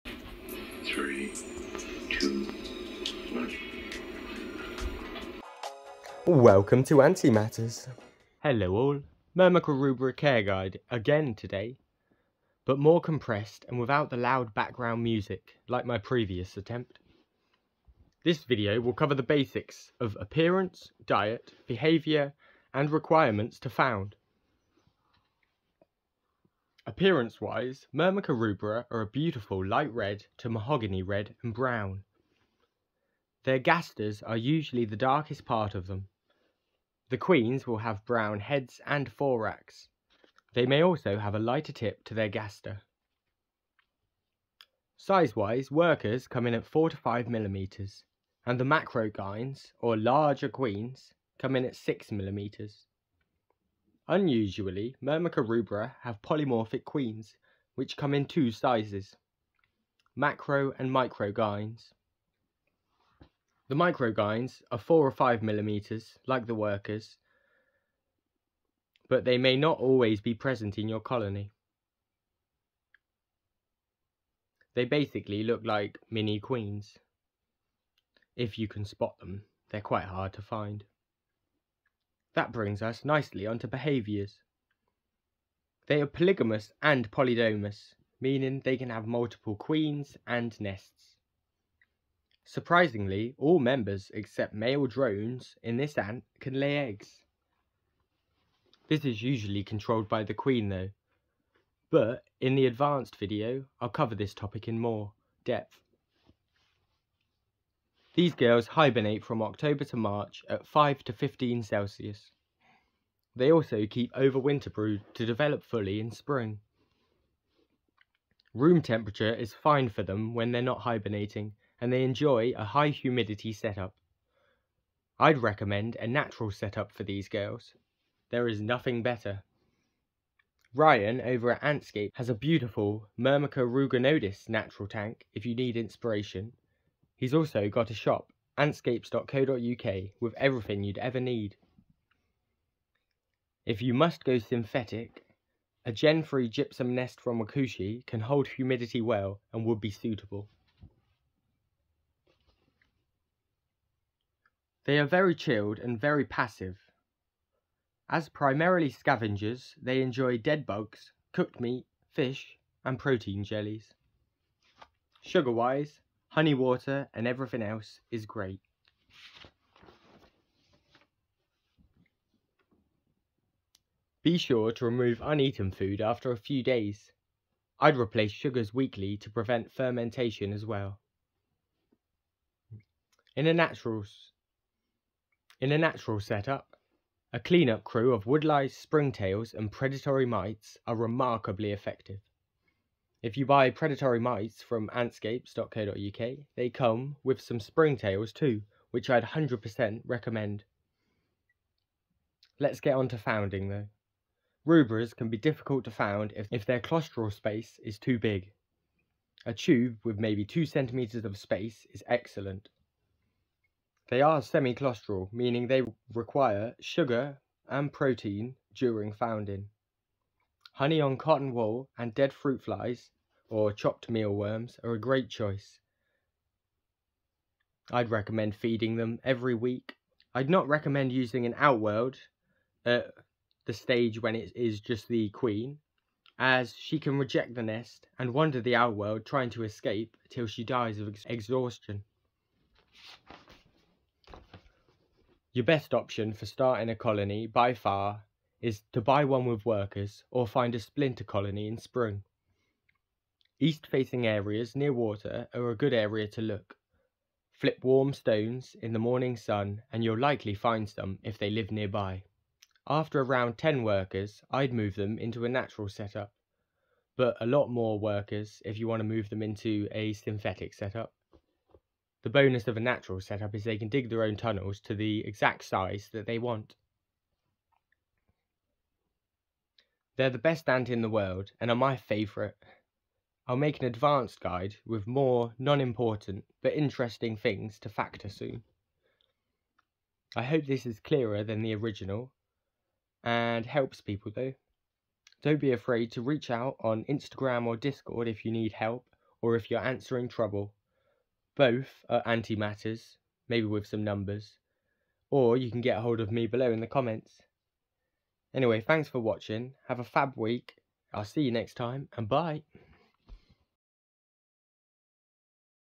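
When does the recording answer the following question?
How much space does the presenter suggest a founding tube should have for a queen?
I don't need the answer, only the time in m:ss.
3:30.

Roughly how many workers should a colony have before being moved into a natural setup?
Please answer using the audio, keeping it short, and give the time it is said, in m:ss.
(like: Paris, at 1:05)
10, at 4:23.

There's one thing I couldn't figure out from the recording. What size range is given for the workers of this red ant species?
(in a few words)
4 to 5 millimeters.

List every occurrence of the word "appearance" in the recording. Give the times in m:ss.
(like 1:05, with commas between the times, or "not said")
0:20, 0:26.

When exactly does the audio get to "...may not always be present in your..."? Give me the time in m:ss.
1:09.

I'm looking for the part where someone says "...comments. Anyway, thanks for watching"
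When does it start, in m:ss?
5:06.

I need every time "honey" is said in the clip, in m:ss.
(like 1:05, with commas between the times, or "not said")
2:46, 3:40.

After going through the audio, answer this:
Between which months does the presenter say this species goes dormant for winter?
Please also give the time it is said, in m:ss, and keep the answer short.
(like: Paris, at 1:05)
October to March, at 1:49.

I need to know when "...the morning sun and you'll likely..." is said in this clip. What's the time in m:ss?
4:18.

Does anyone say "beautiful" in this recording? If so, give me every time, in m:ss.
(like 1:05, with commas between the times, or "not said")
0:29, 2:12.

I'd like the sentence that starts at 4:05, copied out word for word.
Your best option for starting a colony by far is to buy one with workers or find a splinter colony in spring.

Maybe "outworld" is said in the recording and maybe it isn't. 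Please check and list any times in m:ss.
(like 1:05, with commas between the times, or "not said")
3:51, 3:58.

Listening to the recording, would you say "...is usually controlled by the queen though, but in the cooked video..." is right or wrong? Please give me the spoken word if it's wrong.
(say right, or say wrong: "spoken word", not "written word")
wrong: "advanced", not "cooked".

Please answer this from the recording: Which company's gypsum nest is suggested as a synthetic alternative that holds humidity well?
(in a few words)
Wakushi.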